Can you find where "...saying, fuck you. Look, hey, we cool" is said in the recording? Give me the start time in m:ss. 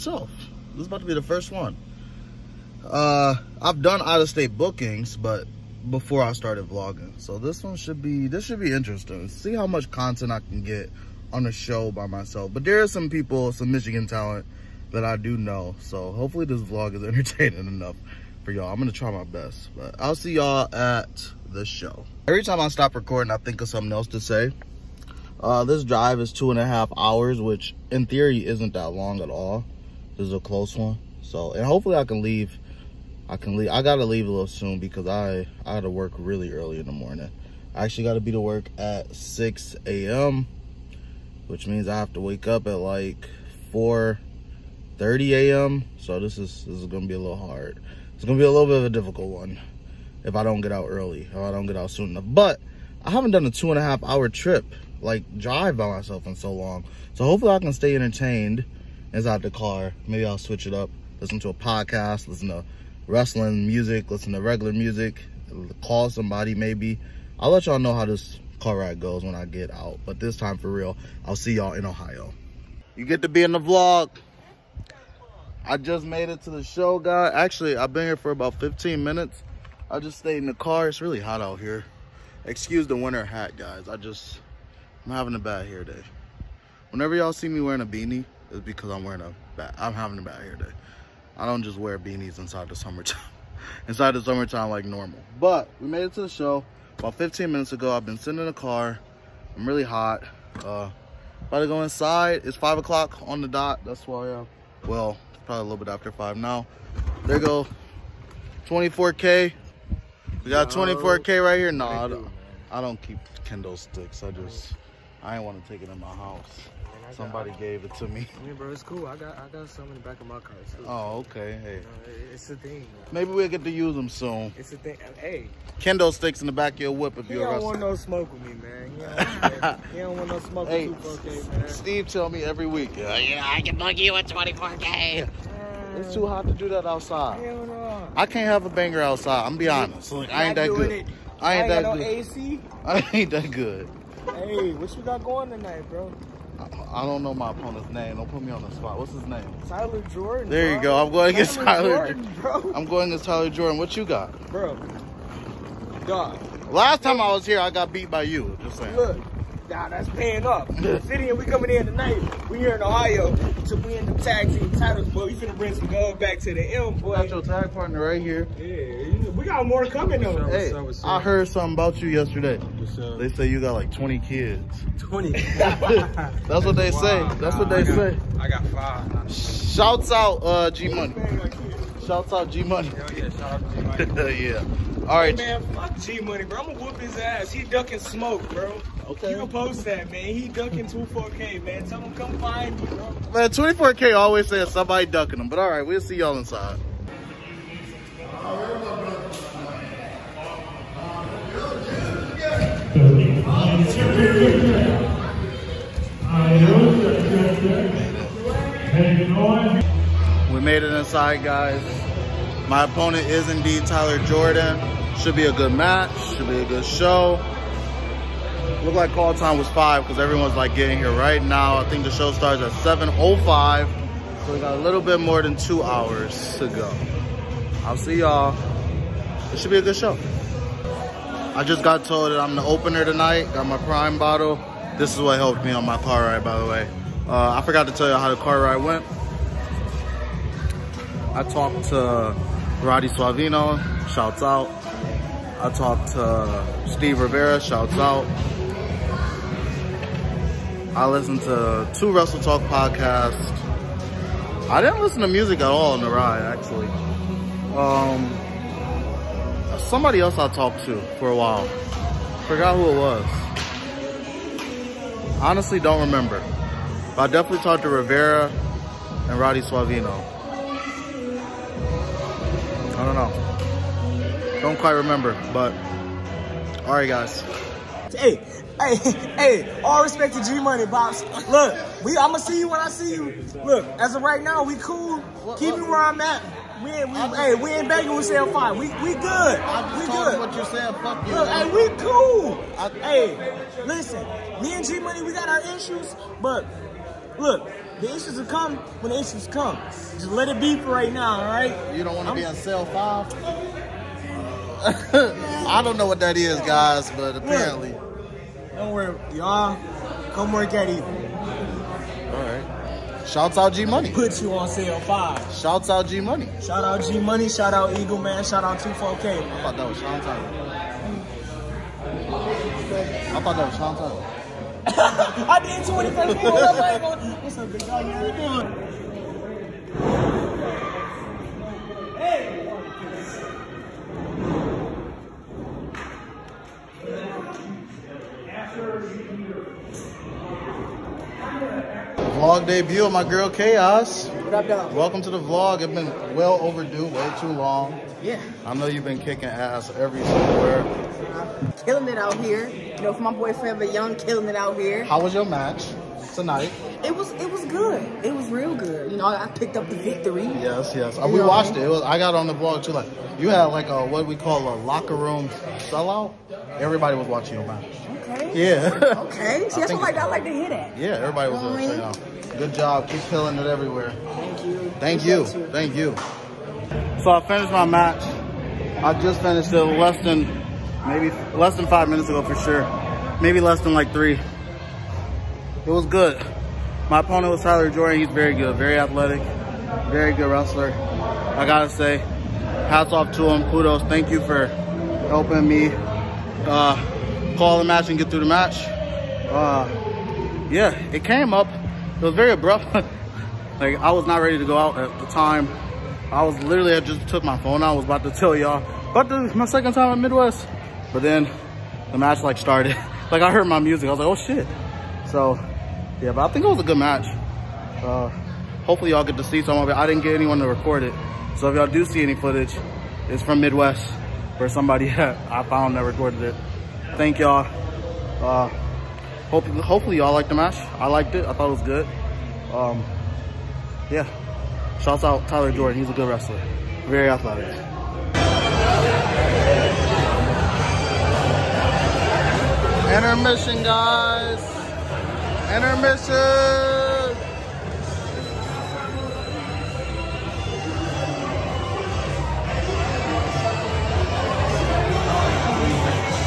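4:50.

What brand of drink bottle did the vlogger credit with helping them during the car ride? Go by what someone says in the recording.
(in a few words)
Prime.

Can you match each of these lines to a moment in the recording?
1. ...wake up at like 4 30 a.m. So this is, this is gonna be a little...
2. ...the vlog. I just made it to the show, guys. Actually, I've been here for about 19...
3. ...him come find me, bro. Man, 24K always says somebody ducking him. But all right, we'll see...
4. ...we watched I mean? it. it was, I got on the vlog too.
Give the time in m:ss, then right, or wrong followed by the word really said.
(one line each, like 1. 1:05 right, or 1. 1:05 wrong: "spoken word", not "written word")
1. 0:42 right
2. 1:13 wrong: "15", not "19"
3. 3:11 right
4. 6:01 right.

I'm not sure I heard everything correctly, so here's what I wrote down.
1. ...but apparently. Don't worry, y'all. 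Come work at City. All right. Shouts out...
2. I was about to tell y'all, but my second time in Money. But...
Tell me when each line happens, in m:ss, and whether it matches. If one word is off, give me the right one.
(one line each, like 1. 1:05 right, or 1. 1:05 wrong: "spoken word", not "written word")
1. 5:07 wrong: "Evil", not "City"
2. 6:47 wrong: "Midwest", not "Money".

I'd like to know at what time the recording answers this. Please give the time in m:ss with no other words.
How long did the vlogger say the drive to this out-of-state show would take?
0:26.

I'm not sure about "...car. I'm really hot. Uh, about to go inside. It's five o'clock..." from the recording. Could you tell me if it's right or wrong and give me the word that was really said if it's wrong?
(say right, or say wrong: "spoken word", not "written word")
right.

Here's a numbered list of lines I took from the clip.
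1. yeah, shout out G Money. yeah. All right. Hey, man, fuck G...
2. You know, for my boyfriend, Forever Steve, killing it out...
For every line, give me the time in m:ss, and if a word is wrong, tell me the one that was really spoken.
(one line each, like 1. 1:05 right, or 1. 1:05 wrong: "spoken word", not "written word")
1. 3:03 right
2. 5:52 wrong: "Young", not "Steve".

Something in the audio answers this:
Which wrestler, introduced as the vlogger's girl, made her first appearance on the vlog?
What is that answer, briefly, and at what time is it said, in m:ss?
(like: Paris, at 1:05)
Chaos, at 5:43.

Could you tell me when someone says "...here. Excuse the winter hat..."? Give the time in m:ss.
1:21.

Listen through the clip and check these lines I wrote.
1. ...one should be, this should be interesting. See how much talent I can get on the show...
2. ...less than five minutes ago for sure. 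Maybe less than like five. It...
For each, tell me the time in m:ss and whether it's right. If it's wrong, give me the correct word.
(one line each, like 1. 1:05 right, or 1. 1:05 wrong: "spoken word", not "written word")
1. 0:07 wrong: "content", not "talent"
2. 6:21 wrong: "three", not "five".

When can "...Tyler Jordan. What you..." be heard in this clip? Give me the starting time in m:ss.
2:33.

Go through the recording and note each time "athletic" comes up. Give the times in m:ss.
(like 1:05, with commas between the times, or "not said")
6:28, 7:17.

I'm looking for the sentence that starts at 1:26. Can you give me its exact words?
Whenever y'all see me wearing a beanie, it's because I'm wearing a bad, I'm having a bad hair day.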